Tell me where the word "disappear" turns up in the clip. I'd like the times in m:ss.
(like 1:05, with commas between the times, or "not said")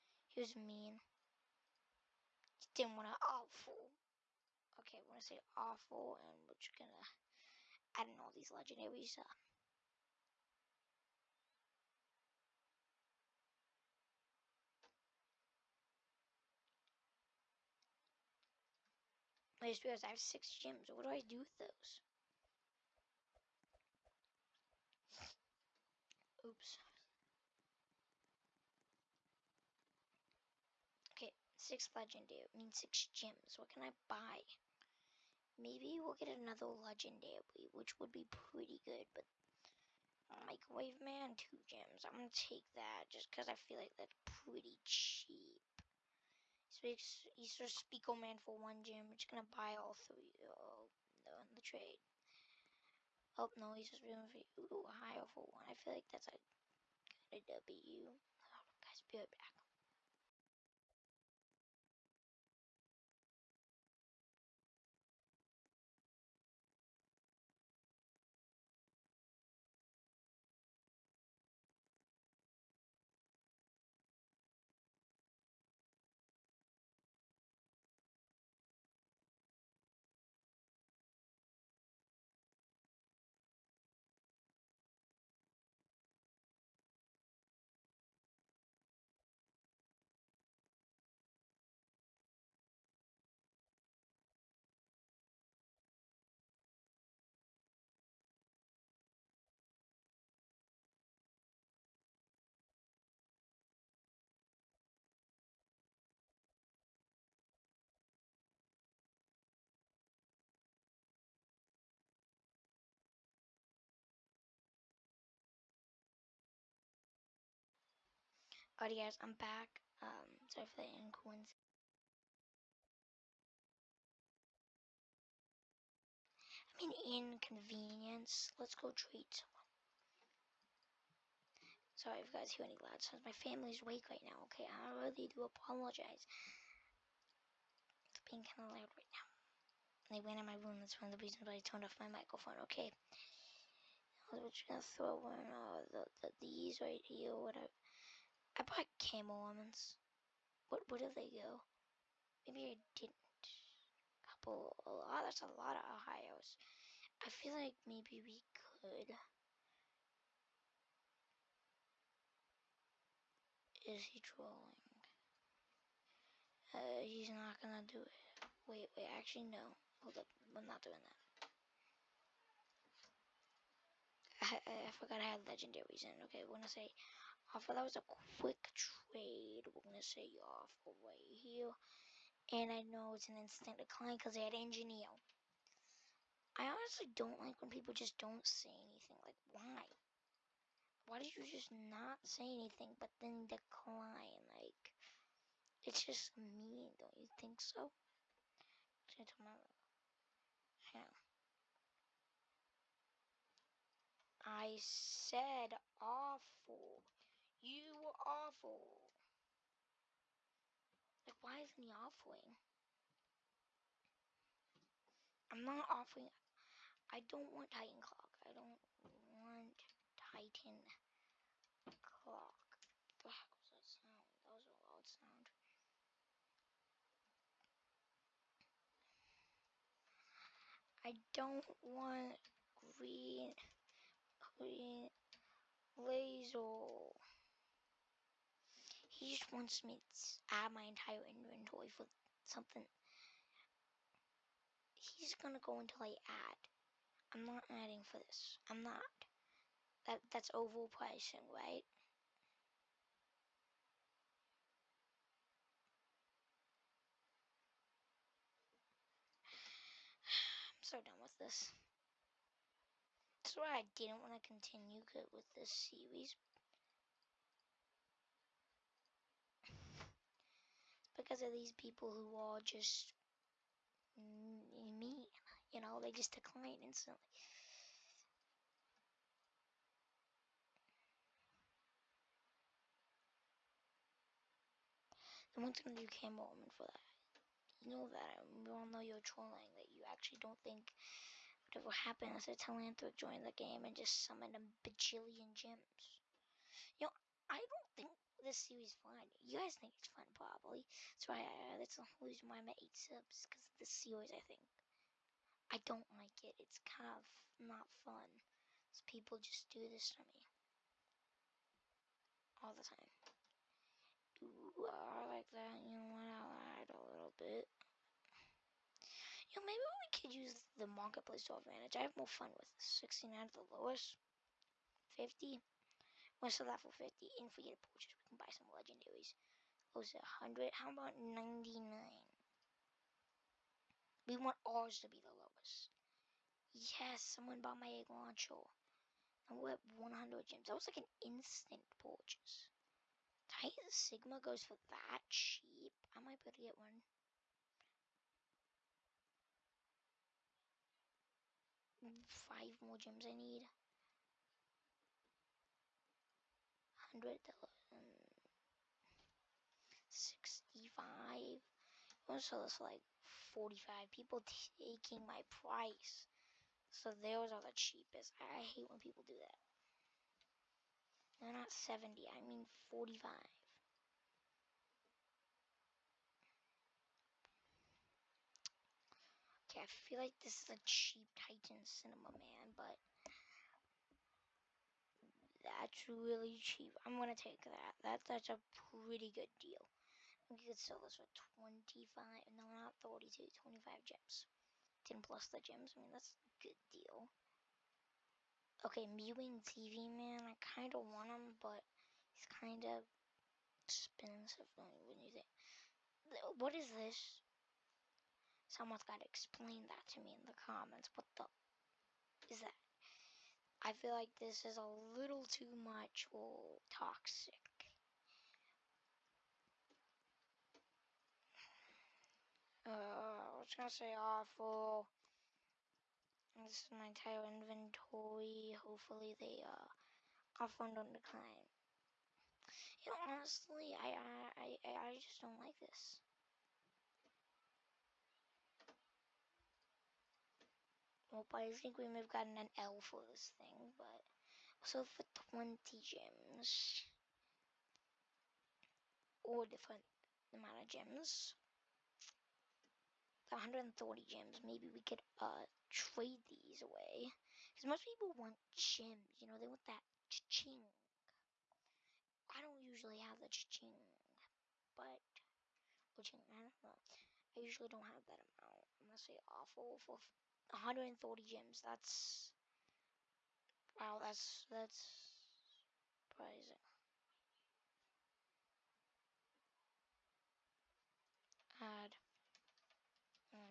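not said.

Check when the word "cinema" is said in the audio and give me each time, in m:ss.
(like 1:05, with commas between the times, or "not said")
6:21.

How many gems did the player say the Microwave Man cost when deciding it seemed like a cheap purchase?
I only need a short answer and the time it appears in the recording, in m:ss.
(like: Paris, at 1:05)
2 gems, at 0:41.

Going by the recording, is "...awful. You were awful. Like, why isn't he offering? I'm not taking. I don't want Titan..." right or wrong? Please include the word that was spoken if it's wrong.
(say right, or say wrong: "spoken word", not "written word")
wrong: "offering", not "taking".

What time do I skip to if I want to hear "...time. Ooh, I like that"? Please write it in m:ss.
5:12.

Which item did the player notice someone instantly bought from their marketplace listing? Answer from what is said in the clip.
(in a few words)
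Egg launcher.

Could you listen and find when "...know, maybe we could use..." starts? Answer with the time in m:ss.
5:19.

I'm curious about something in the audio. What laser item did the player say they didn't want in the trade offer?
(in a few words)
Green laser.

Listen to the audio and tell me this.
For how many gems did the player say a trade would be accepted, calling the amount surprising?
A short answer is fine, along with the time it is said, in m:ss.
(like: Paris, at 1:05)
140, at 7:50.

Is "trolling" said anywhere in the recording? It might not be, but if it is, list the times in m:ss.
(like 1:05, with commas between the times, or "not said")
2:44, 4:49.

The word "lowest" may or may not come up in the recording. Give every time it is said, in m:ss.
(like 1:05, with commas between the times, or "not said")
5:23, 5:35.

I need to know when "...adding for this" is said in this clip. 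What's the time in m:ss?
4:07.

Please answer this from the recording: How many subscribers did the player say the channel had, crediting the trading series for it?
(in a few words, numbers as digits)
8.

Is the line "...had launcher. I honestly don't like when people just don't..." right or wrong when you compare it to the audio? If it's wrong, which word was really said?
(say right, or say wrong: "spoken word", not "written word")
wrong: "engineer", not "launcher".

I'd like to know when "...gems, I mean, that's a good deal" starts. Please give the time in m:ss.
6:35.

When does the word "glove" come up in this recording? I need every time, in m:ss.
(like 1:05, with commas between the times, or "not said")
not said.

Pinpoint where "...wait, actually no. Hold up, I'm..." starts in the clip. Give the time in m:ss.
2:48.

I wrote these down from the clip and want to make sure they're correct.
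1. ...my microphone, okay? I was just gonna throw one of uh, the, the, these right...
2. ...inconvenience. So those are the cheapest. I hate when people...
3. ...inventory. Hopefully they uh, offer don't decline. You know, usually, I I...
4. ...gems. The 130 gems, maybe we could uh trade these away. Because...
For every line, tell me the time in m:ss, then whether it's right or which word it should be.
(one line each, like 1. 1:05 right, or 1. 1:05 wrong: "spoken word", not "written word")
1. 2:21 right
2. 6:05 wrong: "price", not "inconvenience"
3. 7:07 wrong: "honestly", not "usually"
4. 7:30 right.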